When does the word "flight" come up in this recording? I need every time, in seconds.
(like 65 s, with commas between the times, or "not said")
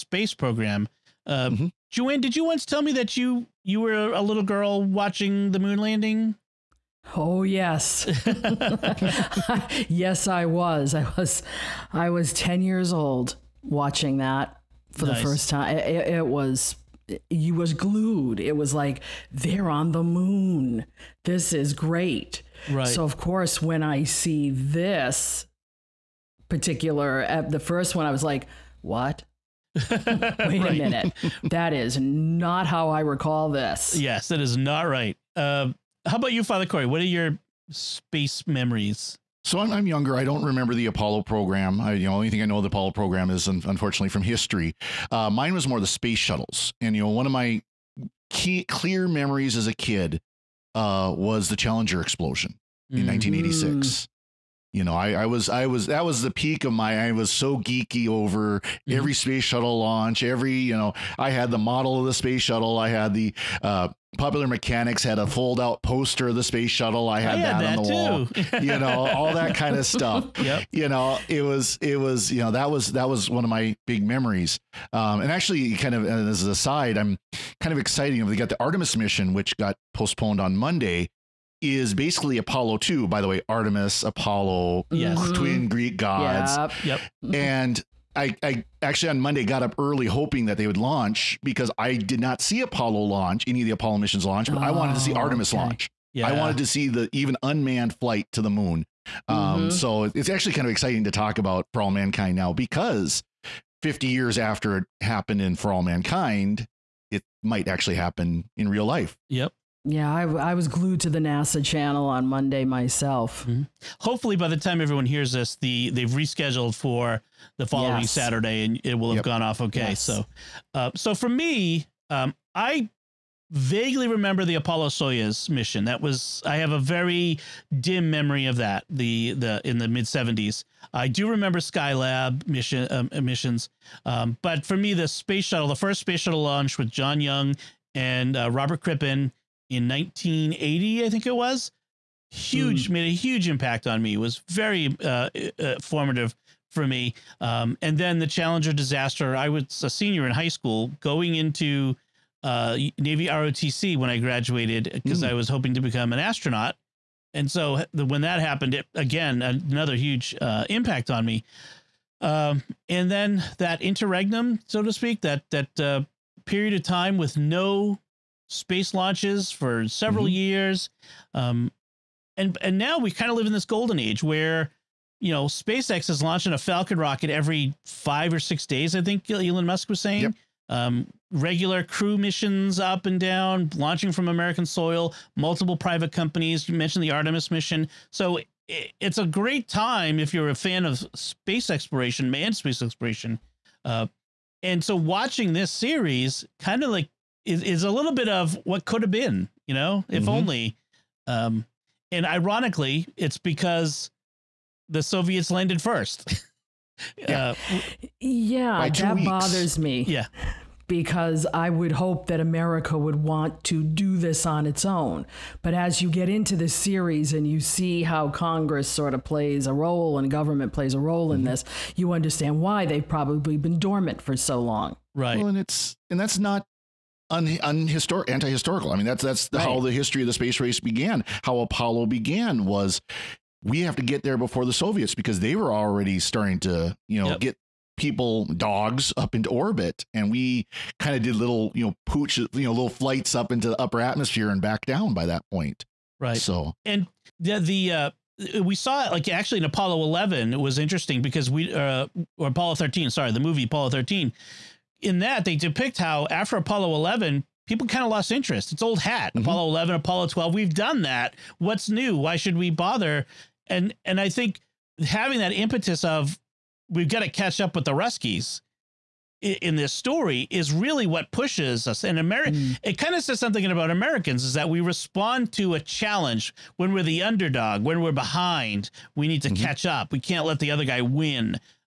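97 s, 242 s.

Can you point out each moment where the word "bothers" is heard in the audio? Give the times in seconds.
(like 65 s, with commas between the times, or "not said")
209 s, 262 s.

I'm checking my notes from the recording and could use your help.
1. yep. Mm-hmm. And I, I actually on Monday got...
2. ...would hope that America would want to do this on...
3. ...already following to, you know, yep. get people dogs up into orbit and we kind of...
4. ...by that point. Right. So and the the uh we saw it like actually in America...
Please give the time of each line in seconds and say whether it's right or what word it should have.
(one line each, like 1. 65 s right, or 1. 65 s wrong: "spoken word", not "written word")
1. 86 s right
2. 211 s right
3. 235 s wrong: "starting", not "following"
4. 245 s wrong: "Apollo", not "America".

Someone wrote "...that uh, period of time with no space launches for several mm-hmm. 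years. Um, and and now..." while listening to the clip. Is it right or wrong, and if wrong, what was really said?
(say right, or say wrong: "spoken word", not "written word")
right.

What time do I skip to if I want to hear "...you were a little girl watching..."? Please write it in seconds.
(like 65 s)
3 s.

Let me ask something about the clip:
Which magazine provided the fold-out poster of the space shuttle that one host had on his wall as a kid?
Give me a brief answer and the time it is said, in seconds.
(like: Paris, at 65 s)
Popular Mechanics, at 64 s.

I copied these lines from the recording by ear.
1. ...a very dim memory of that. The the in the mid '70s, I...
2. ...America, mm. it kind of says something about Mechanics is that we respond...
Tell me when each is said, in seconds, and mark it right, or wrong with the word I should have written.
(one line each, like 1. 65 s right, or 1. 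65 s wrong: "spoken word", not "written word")
1. 126 s right
2. 272 s wrong: "Americans", not "Mechanics".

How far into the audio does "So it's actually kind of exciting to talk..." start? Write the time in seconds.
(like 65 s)
99 s.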